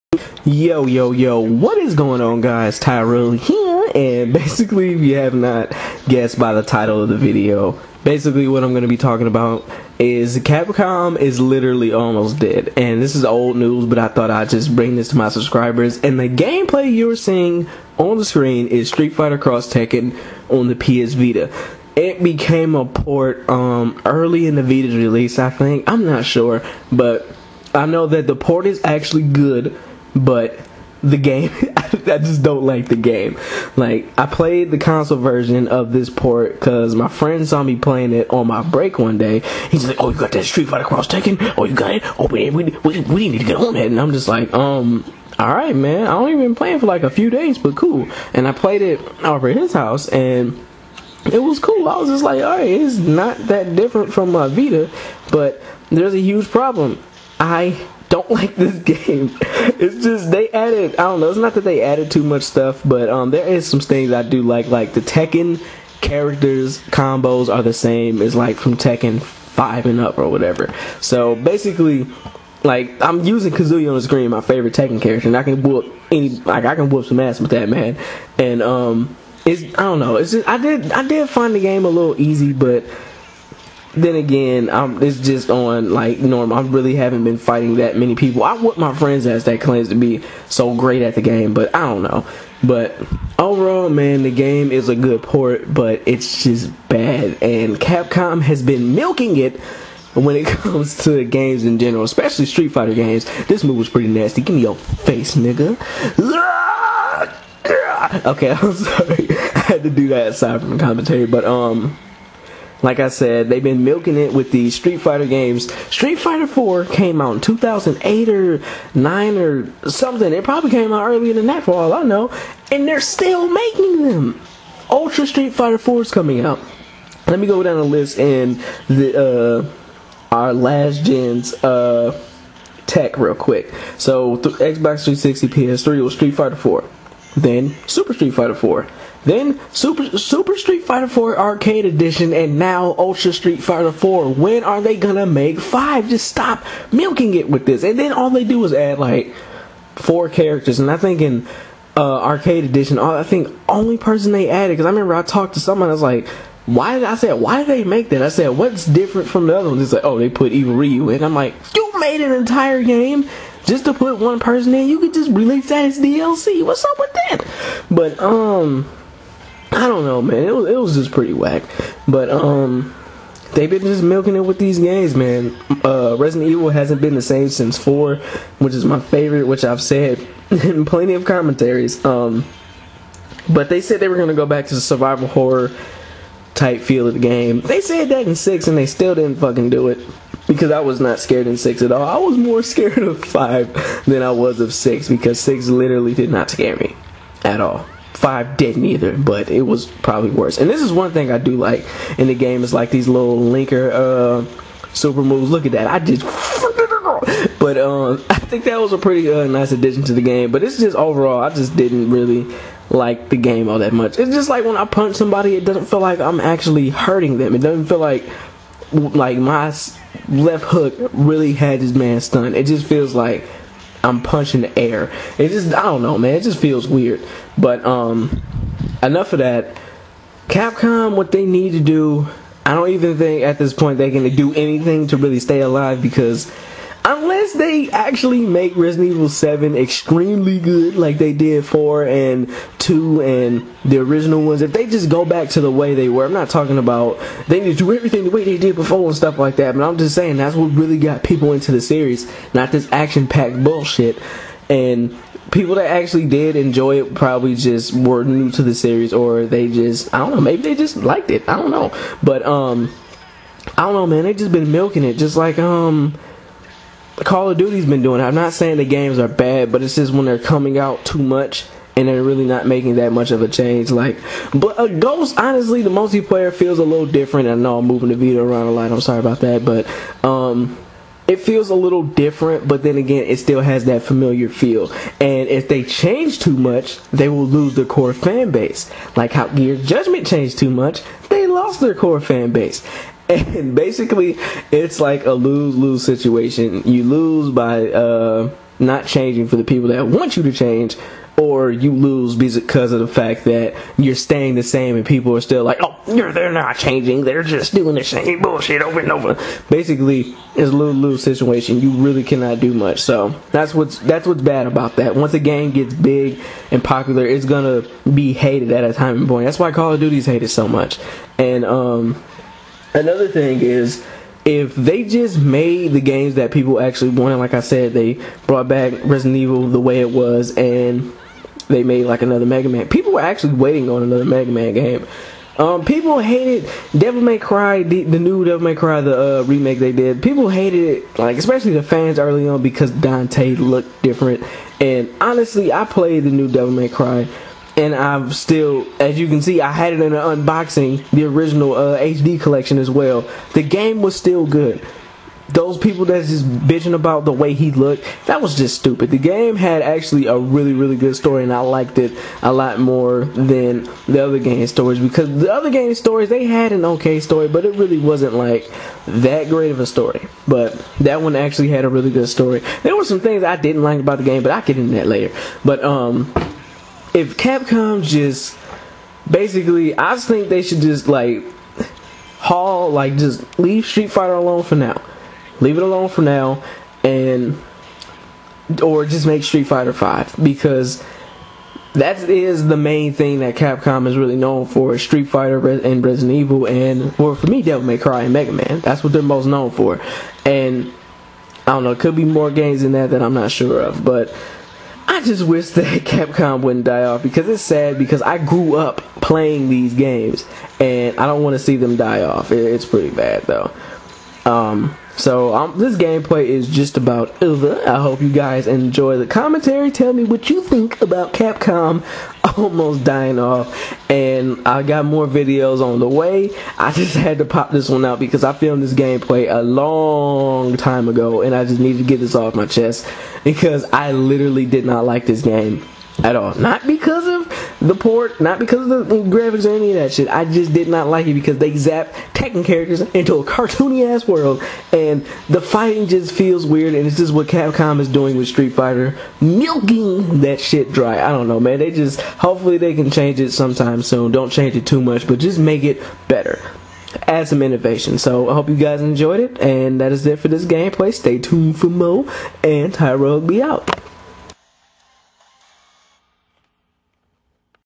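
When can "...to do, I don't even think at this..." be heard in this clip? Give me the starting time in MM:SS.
03:51.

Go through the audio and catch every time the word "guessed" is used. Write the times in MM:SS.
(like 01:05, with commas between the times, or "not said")
00:06.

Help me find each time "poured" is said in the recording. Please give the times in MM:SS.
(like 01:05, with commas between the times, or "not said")
not said.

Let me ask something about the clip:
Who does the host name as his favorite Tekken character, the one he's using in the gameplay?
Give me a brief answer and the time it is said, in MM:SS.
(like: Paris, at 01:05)
Kazuya, at 01:13.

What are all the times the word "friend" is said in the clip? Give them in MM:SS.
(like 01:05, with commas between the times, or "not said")
00:37, 01:28.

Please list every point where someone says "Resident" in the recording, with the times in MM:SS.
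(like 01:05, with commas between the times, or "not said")
02:56, 03:58, 05:29, 06:36.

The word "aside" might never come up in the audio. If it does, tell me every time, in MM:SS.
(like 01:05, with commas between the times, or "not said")
01:50.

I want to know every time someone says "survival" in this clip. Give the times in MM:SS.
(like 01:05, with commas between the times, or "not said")
03:04.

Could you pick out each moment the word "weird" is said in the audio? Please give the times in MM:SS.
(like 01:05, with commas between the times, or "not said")
03:46, 07:26.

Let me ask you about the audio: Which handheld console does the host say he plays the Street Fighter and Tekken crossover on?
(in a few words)
PS Vita.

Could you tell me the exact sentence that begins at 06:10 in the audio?
But that one actually had a really good story.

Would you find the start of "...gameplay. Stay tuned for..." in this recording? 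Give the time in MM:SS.
07:40.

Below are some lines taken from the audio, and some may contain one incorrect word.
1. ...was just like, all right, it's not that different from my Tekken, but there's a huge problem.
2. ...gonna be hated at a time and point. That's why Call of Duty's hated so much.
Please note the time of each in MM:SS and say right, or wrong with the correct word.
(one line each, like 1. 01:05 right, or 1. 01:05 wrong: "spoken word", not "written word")
1. 00:51 wrong: "Vita", not "Tekken"
2. 05:17 right.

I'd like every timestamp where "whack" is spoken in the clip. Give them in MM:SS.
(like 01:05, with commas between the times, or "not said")
02:51.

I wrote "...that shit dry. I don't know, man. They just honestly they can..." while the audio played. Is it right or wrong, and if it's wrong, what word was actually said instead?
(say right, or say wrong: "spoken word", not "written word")
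wrong: "hopefully", not "honestly".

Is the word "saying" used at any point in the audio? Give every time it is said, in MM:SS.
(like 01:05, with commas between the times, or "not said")
04:10, 04:28.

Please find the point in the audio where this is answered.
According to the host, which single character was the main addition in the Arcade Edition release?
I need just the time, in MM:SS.
02:40.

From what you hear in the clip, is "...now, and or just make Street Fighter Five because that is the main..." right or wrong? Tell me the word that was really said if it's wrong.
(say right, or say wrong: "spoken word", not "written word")
right.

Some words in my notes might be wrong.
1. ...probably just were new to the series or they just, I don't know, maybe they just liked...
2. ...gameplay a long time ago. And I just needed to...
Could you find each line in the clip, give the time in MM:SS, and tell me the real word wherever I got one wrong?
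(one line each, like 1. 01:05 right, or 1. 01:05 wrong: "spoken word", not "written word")
1. 04:17 right
2. 07:08 right.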